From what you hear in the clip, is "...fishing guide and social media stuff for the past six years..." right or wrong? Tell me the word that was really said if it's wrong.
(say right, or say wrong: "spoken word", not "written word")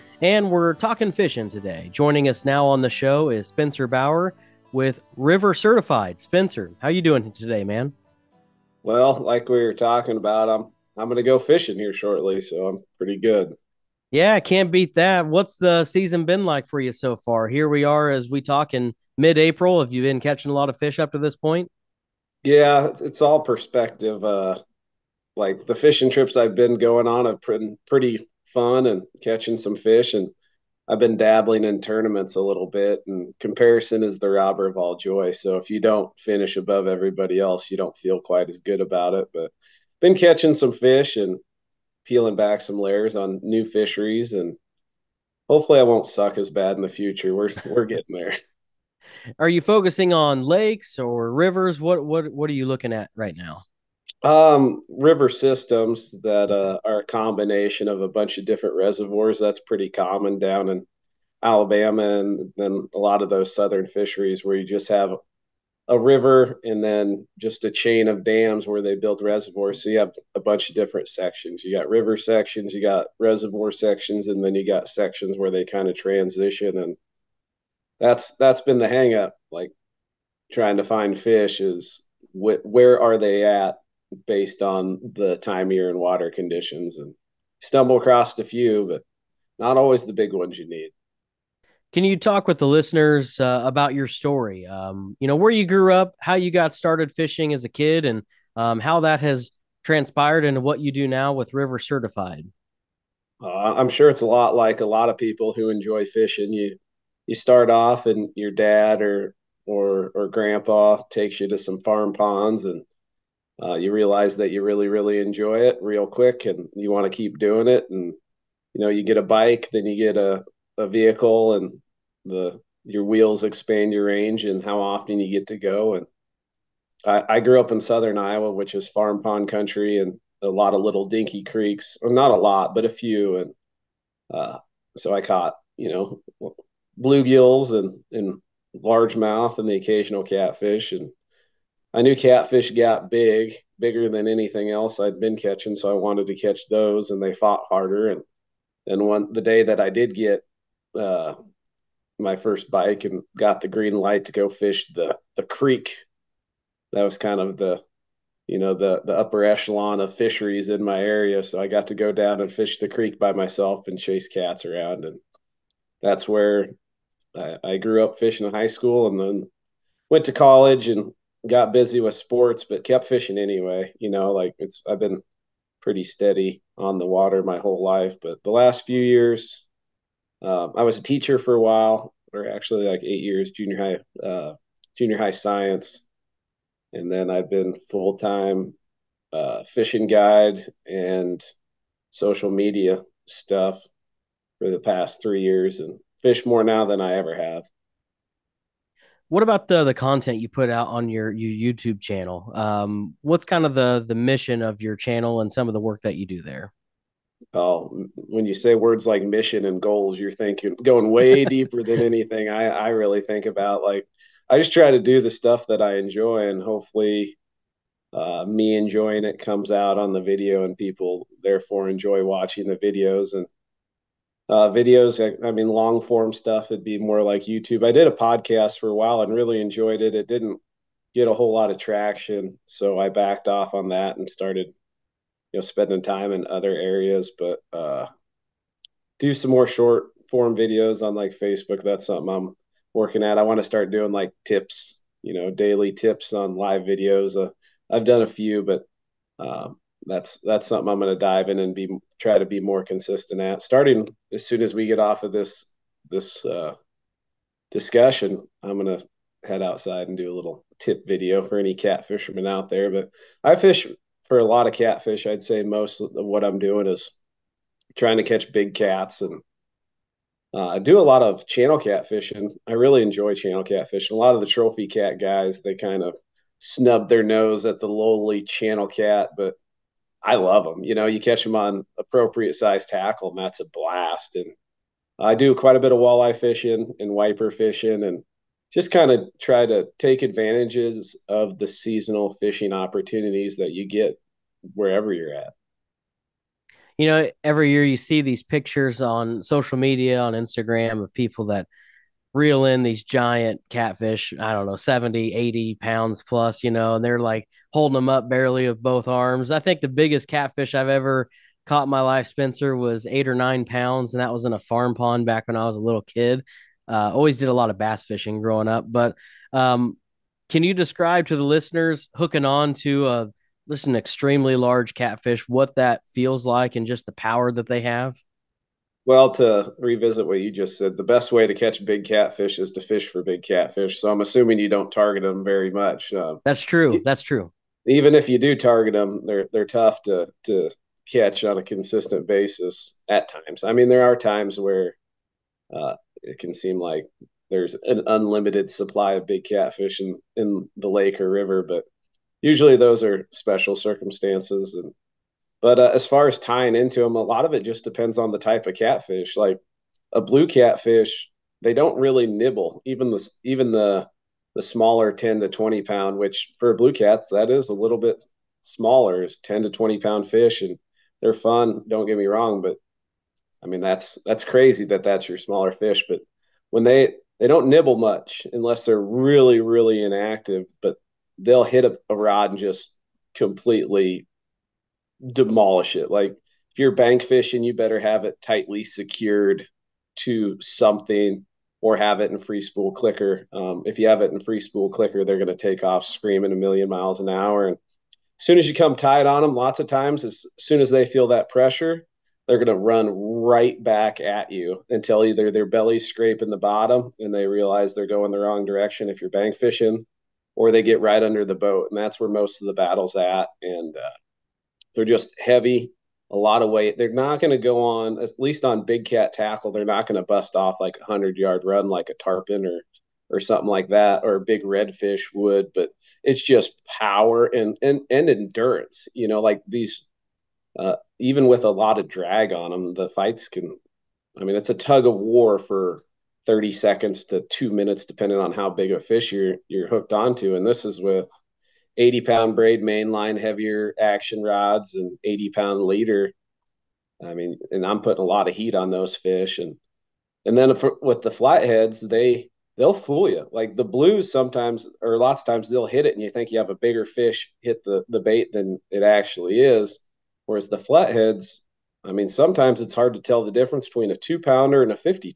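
wrong: "three", not "six".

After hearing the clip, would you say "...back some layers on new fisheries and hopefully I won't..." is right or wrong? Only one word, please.
right.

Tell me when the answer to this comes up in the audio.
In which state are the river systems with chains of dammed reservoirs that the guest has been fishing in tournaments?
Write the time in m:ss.
1:01.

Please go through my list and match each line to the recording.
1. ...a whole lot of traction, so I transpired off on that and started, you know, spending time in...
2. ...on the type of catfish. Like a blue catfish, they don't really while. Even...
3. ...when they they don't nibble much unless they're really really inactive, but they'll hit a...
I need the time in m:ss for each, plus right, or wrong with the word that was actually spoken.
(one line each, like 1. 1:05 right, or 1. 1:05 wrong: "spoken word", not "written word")
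1. 3:51 wrong: "backed", not "transpired"
2. 5:58 wrong: "nibble", not "while"
3. 6:16 right.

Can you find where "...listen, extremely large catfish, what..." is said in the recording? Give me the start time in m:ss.
5:23.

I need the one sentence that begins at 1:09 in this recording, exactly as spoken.
So you have a bunch of different sections.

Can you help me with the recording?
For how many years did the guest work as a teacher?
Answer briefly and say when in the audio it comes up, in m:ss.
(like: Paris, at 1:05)
8, at 3:03.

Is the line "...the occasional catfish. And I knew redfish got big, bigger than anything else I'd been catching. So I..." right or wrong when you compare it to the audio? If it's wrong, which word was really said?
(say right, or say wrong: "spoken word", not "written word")
wrong: "catfish", not "redfish".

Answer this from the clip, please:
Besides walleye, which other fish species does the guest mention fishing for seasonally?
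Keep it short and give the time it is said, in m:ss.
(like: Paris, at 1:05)
wiper, at 4:47.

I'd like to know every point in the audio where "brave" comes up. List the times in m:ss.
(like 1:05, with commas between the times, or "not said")
not said.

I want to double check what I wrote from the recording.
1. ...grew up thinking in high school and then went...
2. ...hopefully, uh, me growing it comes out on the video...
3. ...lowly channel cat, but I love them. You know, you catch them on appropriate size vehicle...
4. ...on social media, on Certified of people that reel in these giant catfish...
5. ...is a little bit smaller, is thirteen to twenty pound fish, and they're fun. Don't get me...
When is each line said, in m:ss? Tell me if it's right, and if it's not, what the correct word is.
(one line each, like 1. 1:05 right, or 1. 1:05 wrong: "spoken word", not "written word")
1. 2:47 wrong: "fishing", not "thinking"
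2. 3:36 wrong: "enjoying", not "growing"
3. 4:37 wrong: "tackle", not "vehicle"
4. 4:59 wrong: "Instagram", not "Certified"
5. 6:07 wrong: "ten", not "thirteen".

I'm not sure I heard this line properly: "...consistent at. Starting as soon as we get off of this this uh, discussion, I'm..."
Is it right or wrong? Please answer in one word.
right.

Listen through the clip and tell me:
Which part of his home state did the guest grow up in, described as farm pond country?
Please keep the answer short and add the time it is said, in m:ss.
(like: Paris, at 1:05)
southern Iowa, at 2:07.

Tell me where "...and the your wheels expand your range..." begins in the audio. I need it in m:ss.
2:01.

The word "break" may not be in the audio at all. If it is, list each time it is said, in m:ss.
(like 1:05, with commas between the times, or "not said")
not said.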